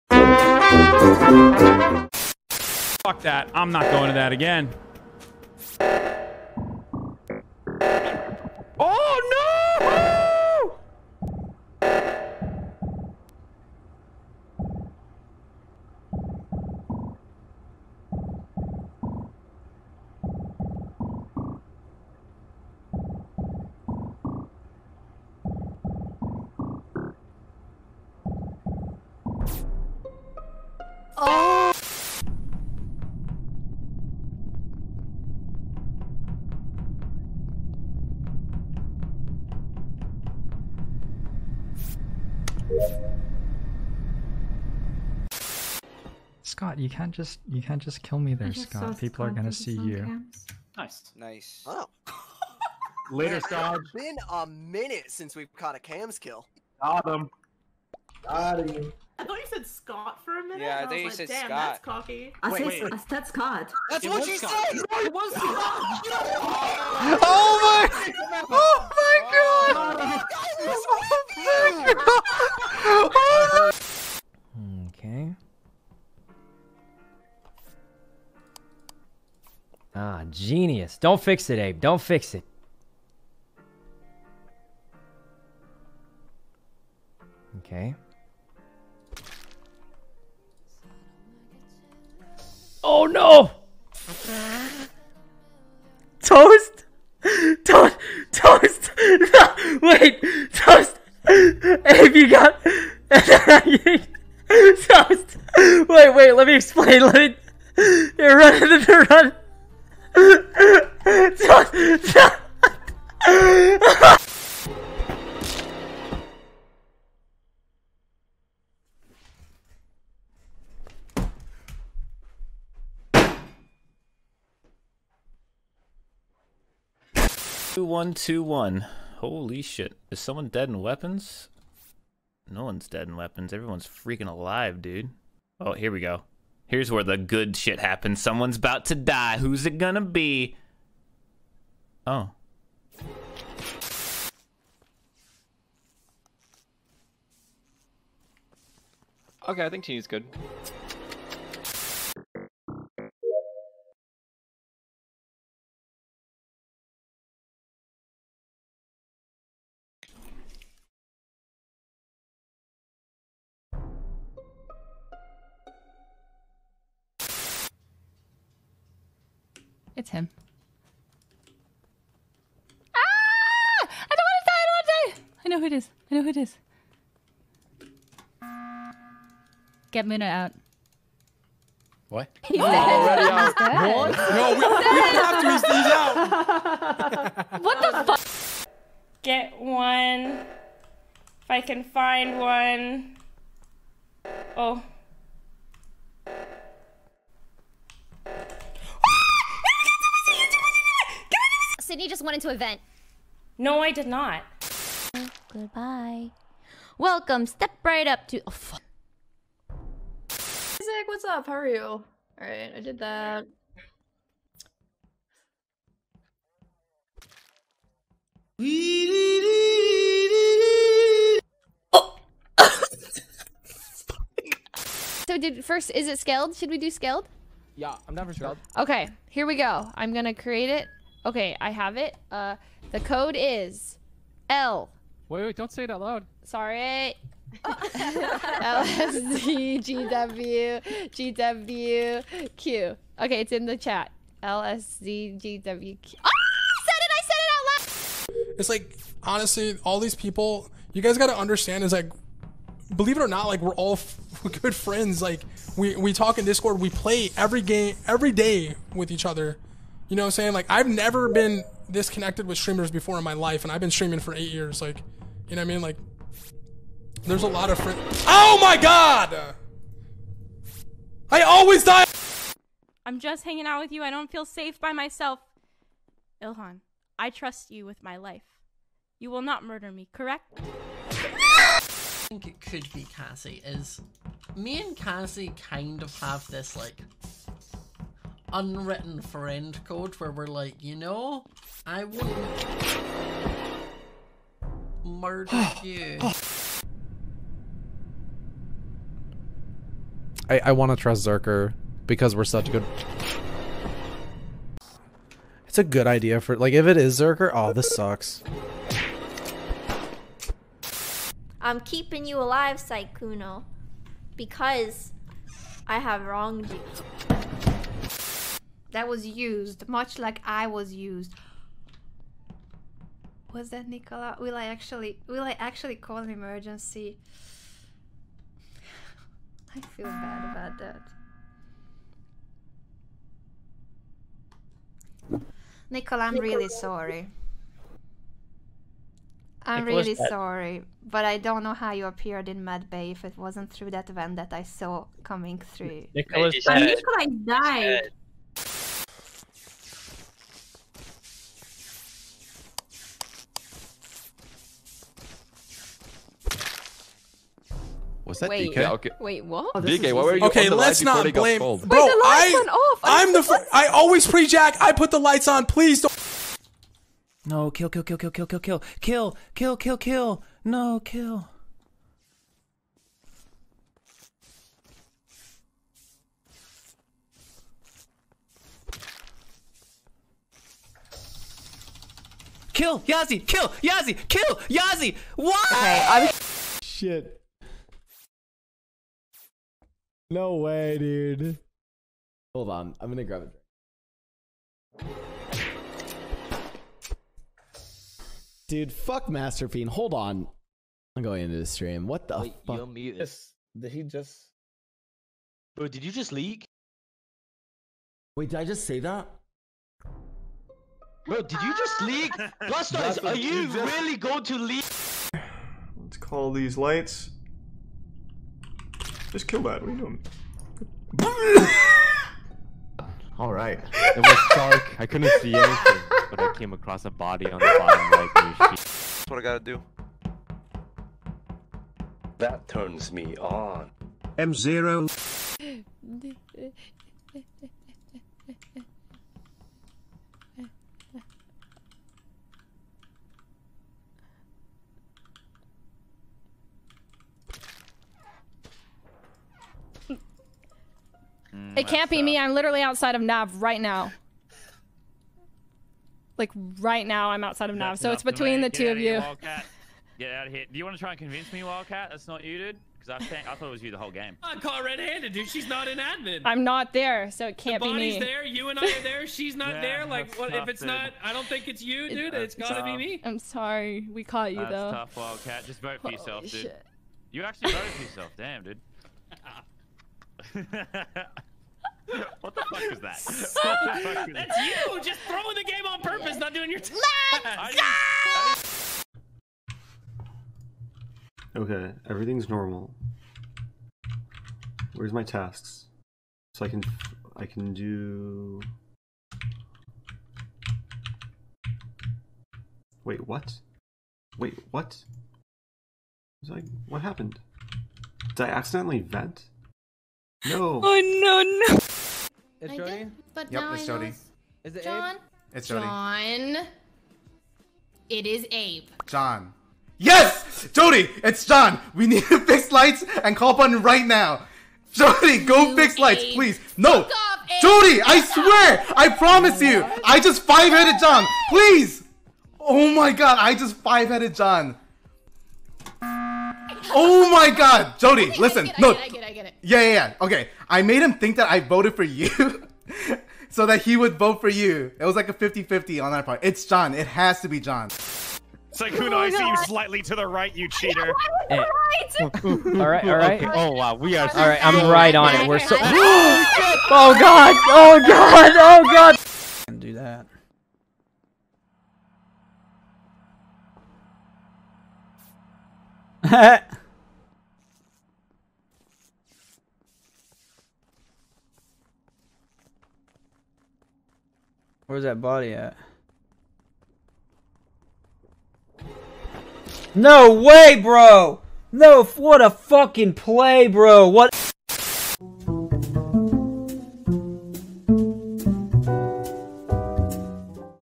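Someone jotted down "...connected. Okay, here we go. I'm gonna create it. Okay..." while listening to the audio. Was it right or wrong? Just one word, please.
wrong.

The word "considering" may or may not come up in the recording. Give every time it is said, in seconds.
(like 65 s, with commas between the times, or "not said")
not said.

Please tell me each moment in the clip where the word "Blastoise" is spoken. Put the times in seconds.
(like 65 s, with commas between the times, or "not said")
412 s.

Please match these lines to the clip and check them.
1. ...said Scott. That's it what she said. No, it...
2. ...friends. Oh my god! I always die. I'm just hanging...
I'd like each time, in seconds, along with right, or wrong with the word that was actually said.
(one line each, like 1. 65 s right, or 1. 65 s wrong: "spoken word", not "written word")
1. 63 s right
2. 267 s right.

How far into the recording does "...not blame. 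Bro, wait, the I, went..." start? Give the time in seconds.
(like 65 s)
361 s.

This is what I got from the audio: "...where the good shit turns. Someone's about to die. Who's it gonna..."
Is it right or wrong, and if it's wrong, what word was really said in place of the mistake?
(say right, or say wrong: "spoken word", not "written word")
wrong: "happens", not "turns".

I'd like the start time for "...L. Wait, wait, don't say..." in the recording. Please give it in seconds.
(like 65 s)
234 s.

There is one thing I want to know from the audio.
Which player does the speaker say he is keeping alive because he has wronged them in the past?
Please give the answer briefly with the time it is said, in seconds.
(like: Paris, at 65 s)
Sykkuno, at 312 s.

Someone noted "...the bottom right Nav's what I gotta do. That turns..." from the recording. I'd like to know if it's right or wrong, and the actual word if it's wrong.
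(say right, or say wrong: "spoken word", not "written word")
wrong: "That", not "Nav".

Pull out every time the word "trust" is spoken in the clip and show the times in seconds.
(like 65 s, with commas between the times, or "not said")
277 s, 300 s.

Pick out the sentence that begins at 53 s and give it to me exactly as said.
It's been a minute since we've caught a cams kill.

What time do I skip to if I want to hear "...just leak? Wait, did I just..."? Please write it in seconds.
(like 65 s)
406 s.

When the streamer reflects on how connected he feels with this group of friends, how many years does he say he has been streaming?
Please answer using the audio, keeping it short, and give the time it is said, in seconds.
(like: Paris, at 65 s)
8, at 264 s.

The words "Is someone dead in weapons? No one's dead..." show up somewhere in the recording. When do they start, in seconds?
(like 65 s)
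130 s.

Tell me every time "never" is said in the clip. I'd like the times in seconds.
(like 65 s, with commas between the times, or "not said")
228 s, 260 s.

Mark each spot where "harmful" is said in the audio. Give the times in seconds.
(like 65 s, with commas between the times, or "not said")
not said.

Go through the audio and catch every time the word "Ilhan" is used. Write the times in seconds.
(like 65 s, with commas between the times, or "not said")
276 s.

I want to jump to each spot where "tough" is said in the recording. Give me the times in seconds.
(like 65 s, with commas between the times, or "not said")
470 s, 475 s.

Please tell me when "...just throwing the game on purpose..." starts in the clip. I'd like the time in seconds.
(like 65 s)
485 s.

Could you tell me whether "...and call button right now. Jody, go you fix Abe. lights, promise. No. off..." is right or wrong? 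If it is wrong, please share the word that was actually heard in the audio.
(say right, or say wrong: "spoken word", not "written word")
wrong: "please", not "promise".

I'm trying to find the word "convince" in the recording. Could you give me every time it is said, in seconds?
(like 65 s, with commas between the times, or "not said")
461 s.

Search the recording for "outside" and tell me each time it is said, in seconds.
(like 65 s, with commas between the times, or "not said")
452 s, 457 s.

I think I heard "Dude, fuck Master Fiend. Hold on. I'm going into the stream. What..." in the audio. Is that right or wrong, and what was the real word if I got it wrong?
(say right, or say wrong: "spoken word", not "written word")
right.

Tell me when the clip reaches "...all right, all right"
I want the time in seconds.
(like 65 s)
552 s.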